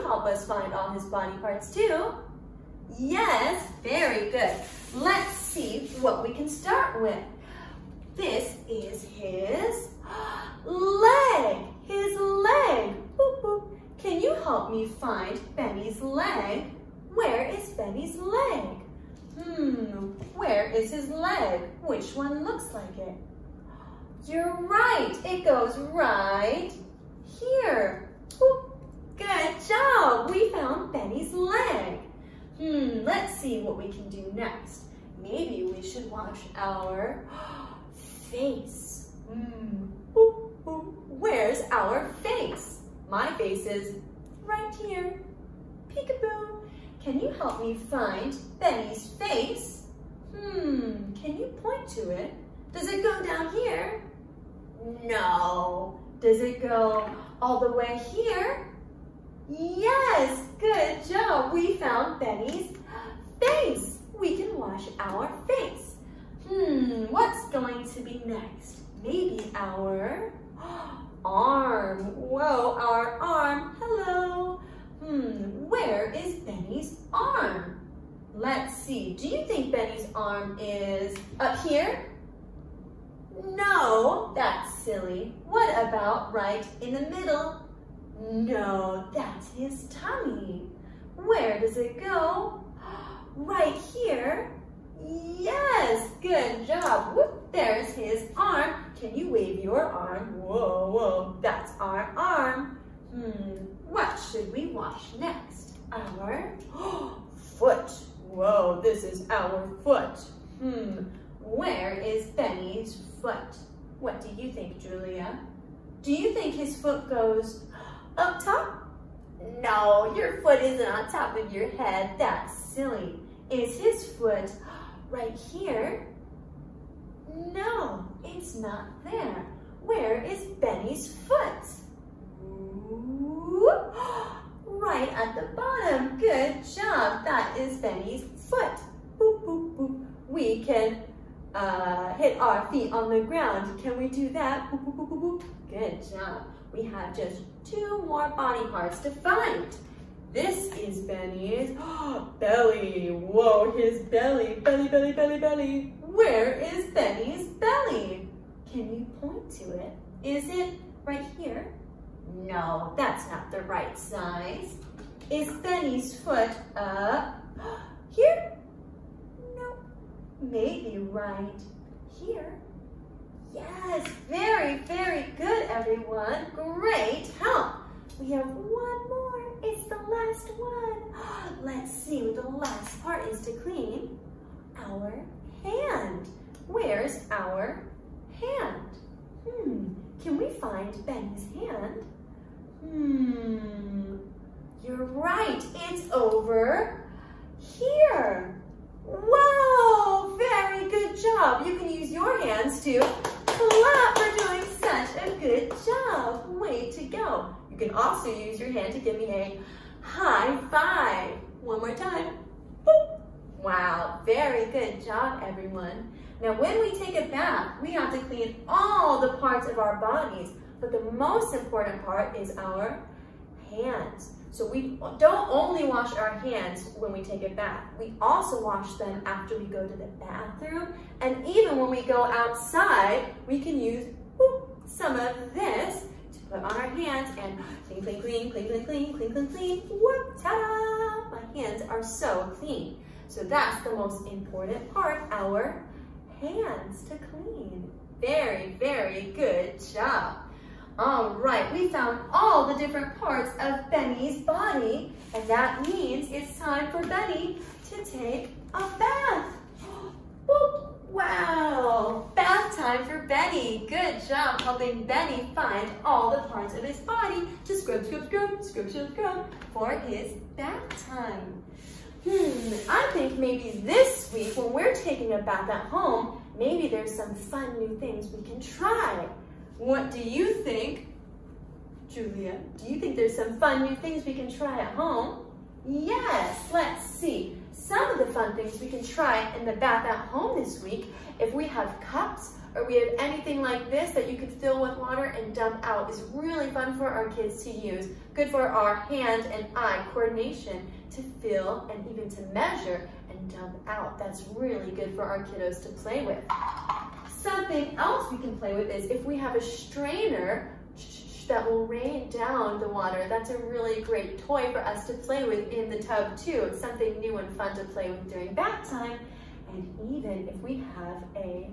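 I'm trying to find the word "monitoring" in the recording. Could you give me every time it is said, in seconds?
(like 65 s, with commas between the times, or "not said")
not said.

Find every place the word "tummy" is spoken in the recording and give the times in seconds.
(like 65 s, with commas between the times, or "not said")
89 s.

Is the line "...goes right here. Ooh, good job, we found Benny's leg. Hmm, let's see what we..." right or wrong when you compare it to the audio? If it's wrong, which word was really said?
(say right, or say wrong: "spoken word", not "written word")
right.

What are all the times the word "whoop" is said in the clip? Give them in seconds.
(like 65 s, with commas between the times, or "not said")
97 s, 234 s, 239 s.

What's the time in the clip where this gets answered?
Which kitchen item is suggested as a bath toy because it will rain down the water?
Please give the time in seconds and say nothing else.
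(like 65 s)
309 s.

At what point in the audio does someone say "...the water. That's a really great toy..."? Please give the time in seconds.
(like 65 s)
312 s.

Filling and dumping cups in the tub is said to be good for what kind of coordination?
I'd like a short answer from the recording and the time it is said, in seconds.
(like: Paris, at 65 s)
Hand and eye coordination, at 298 s.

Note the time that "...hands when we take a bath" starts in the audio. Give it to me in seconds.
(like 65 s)
226 s.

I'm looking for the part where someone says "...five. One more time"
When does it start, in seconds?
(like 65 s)
210 s.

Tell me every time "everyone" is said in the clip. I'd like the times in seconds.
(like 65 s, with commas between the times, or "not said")
175 s, 215 s.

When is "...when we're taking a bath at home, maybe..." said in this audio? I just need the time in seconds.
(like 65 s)
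274 s.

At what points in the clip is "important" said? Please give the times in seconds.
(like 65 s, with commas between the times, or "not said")
221 s, 244 s.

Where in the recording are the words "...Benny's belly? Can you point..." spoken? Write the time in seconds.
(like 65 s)
156 s.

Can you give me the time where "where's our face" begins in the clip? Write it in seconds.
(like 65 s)
41 s.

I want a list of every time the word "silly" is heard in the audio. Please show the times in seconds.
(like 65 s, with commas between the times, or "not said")
84 s, 122 s.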